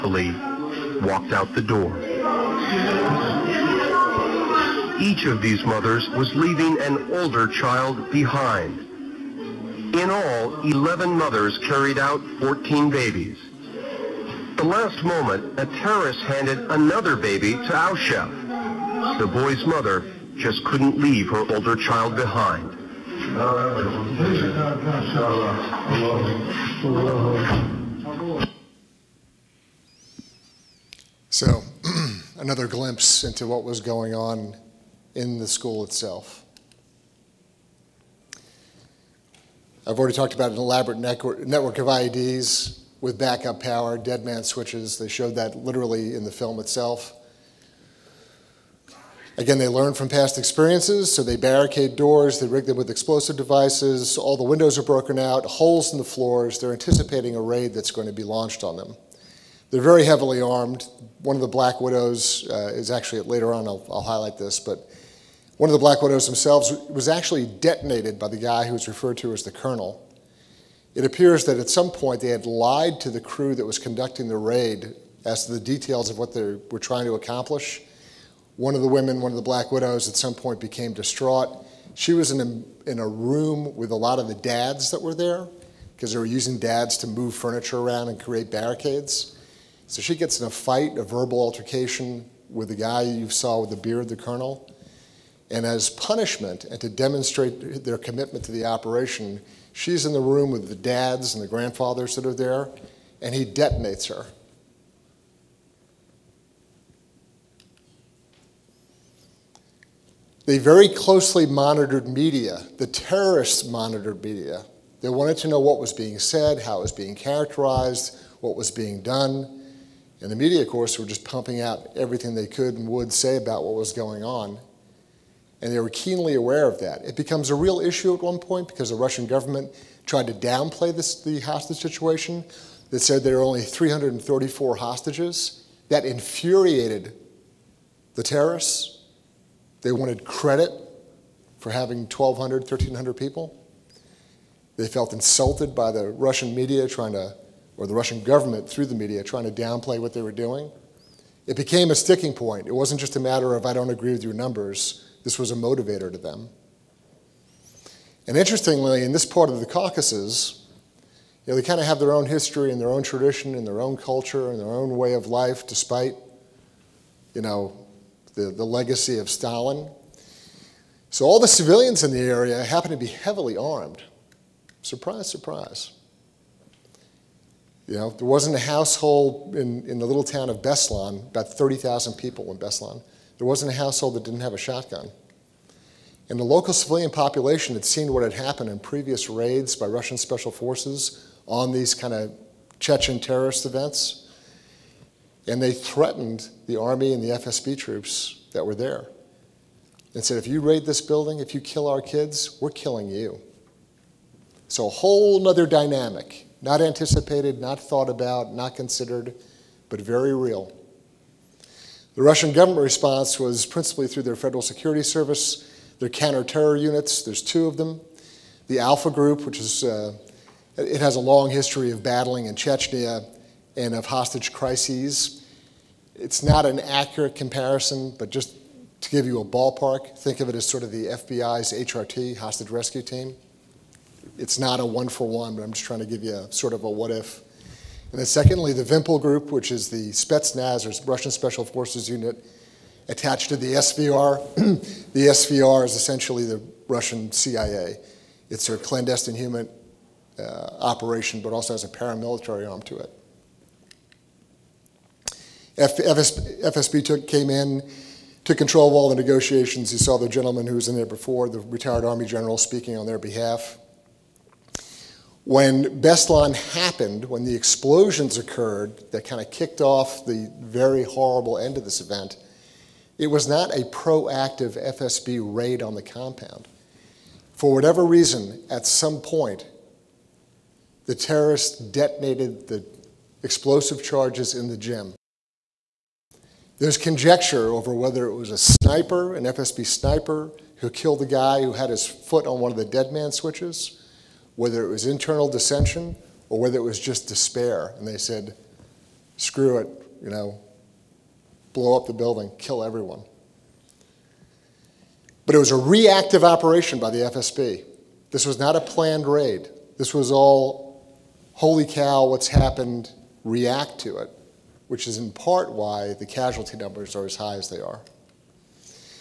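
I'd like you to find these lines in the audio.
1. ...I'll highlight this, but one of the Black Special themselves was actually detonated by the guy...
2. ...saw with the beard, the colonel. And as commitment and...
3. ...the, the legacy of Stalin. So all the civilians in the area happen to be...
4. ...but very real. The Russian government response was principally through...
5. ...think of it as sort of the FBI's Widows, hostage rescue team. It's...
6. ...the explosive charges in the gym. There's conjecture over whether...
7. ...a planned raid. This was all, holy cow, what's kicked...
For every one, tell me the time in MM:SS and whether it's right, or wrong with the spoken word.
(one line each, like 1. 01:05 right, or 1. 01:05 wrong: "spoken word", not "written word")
1. 01:03 wrong: "Widows", not "Special"
2. 01:33 wrong: "punishment", not "commitment"
3. 02:48 right
4. 03:29 right
5. 03:50 wrong: "HRT", not "Widows"
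6. 04:42 right
7. 05:08 wrong: "happened", not "kicked".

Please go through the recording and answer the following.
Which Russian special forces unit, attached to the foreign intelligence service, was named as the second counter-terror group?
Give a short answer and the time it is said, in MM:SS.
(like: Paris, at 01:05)
Vimpel Group, at 03:58.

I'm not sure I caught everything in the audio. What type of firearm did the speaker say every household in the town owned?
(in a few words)
shotgun.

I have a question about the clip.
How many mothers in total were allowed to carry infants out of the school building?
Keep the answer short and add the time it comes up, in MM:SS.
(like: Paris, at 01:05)
11, at 00:10.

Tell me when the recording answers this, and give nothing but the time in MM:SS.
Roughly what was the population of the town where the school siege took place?
03:01.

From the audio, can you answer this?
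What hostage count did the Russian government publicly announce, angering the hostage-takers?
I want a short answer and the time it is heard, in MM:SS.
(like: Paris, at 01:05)
334, at 02:13.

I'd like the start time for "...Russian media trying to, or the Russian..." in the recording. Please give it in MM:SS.
02:26.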